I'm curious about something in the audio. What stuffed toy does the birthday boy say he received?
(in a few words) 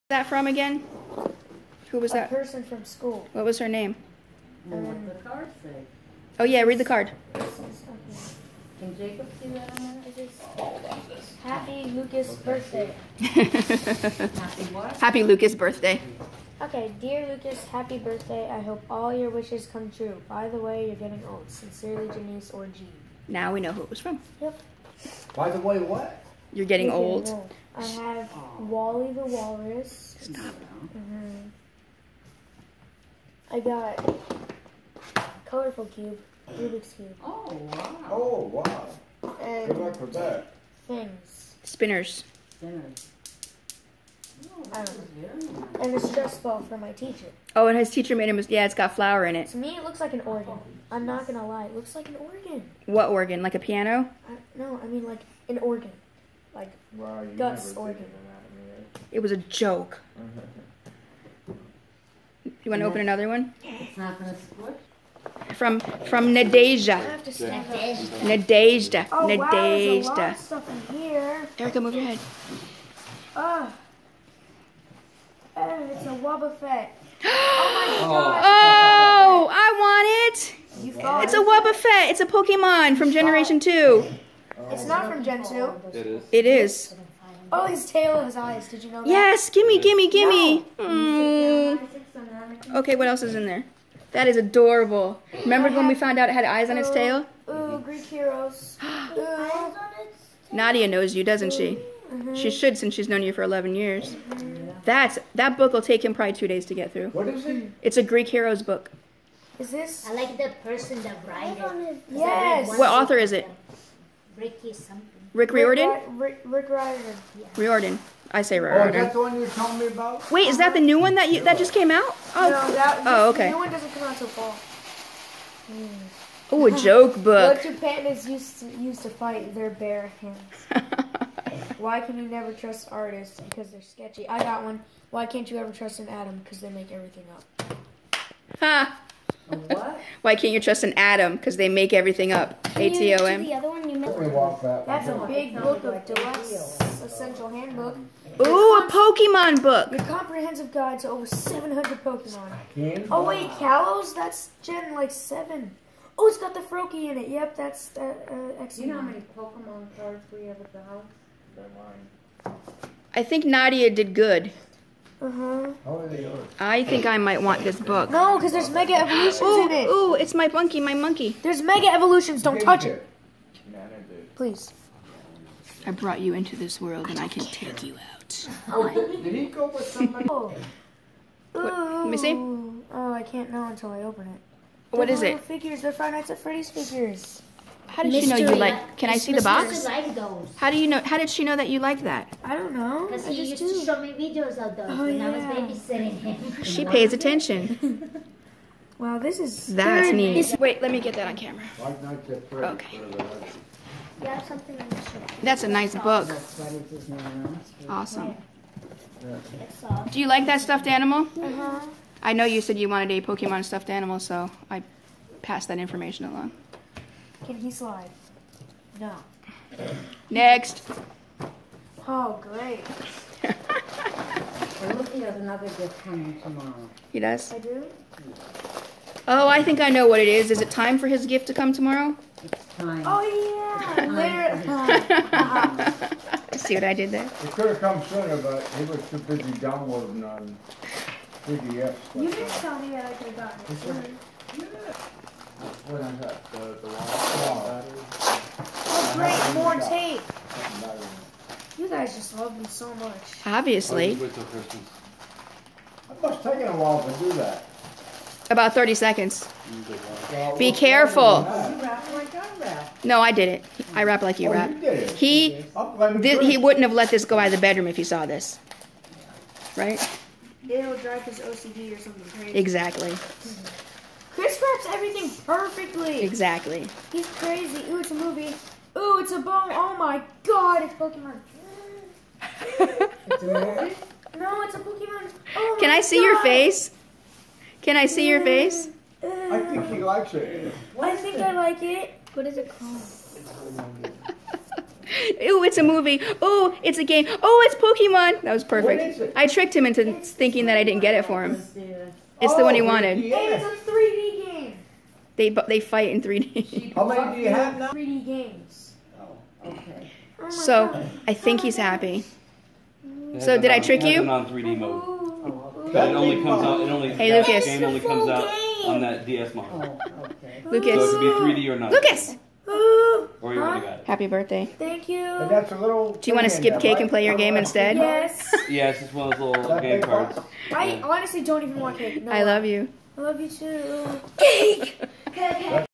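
Wally the Walrus.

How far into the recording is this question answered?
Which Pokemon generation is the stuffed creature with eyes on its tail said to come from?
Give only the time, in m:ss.
1:23.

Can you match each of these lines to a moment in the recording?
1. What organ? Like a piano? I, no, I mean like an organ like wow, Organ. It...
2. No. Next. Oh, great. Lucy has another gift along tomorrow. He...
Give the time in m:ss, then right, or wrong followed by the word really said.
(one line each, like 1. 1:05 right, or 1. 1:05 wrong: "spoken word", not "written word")
1. 0:52 right
2. 3:38 wrong: "coming", not "along".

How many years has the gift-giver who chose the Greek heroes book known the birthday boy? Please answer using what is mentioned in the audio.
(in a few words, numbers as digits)
11.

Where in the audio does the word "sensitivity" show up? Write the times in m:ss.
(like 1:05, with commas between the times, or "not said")
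not said.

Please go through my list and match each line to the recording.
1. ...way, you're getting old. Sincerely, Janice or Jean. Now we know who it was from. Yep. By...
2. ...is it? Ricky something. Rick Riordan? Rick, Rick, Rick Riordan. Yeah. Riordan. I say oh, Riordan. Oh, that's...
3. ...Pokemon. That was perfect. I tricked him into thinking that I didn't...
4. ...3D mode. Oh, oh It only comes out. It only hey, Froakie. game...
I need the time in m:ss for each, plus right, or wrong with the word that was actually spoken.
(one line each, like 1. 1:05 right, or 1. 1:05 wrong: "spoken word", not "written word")
1. 0:20 right
2. 1:53 right
3. 4:57 right
4. 5:14 wrong: "Lukas", not "Froakie".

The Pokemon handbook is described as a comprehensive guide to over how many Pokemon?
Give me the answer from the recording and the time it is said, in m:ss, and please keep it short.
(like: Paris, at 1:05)
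700, at 2:31.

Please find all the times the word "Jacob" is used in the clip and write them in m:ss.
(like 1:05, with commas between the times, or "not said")
0:08.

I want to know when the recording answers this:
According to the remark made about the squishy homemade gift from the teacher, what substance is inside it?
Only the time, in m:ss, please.
0:48.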